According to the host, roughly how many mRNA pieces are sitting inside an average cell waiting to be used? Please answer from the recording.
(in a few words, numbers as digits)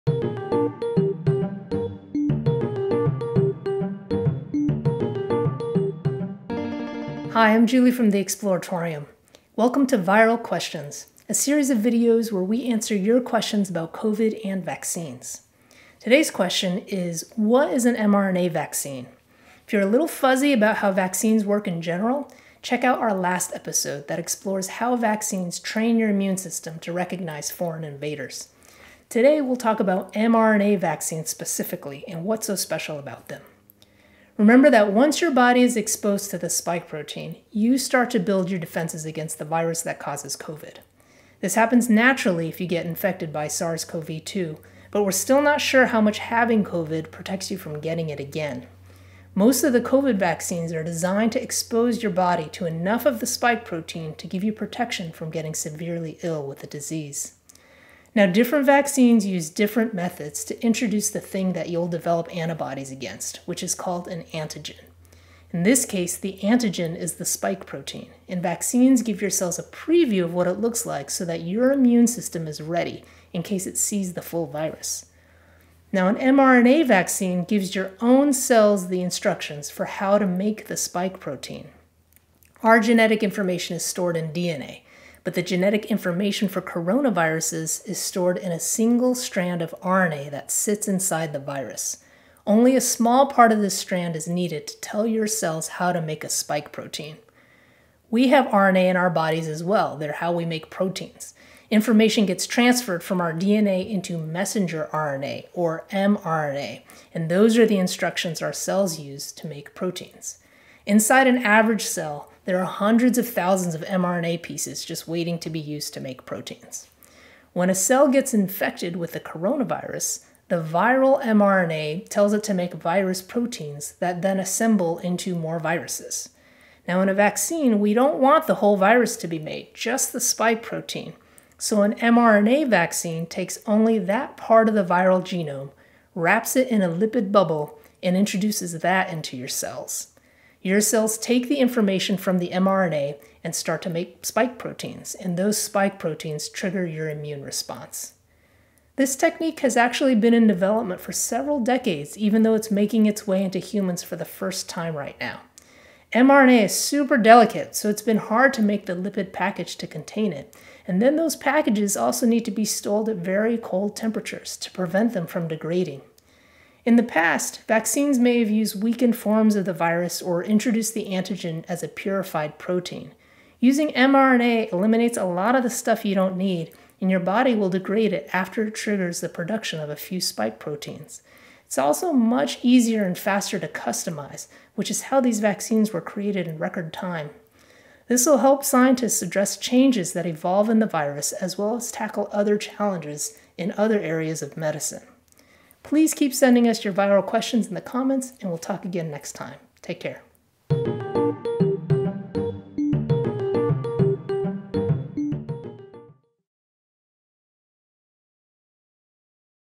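hundreds of thousands.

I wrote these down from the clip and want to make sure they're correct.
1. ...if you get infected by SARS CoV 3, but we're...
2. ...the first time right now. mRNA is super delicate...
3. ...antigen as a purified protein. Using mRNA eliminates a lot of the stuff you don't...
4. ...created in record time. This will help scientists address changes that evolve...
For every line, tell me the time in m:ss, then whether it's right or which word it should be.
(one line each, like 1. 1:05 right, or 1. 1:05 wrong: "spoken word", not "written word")
1. 0:42 wrong: "2", not "3"
2. 2:34 right
3. 2:51 right
4. 3:06 right.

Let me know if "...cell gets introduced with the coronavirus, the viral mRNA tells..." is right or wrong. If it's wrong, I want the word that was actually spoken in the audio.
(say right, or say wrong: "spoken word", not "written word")
wrong: "infected", not "introduced".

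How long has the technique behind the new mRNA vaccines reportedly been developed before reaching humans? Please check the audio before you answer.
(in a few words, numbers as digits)
several decades.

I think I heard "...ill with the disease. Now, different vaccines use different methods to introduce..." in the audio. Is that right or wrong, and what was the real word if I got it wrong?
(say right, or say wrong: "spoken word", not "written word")
right.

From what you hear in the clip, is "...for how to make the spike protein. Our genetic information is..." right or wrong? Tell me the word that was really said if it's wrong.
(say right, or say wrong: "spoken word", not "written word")
right.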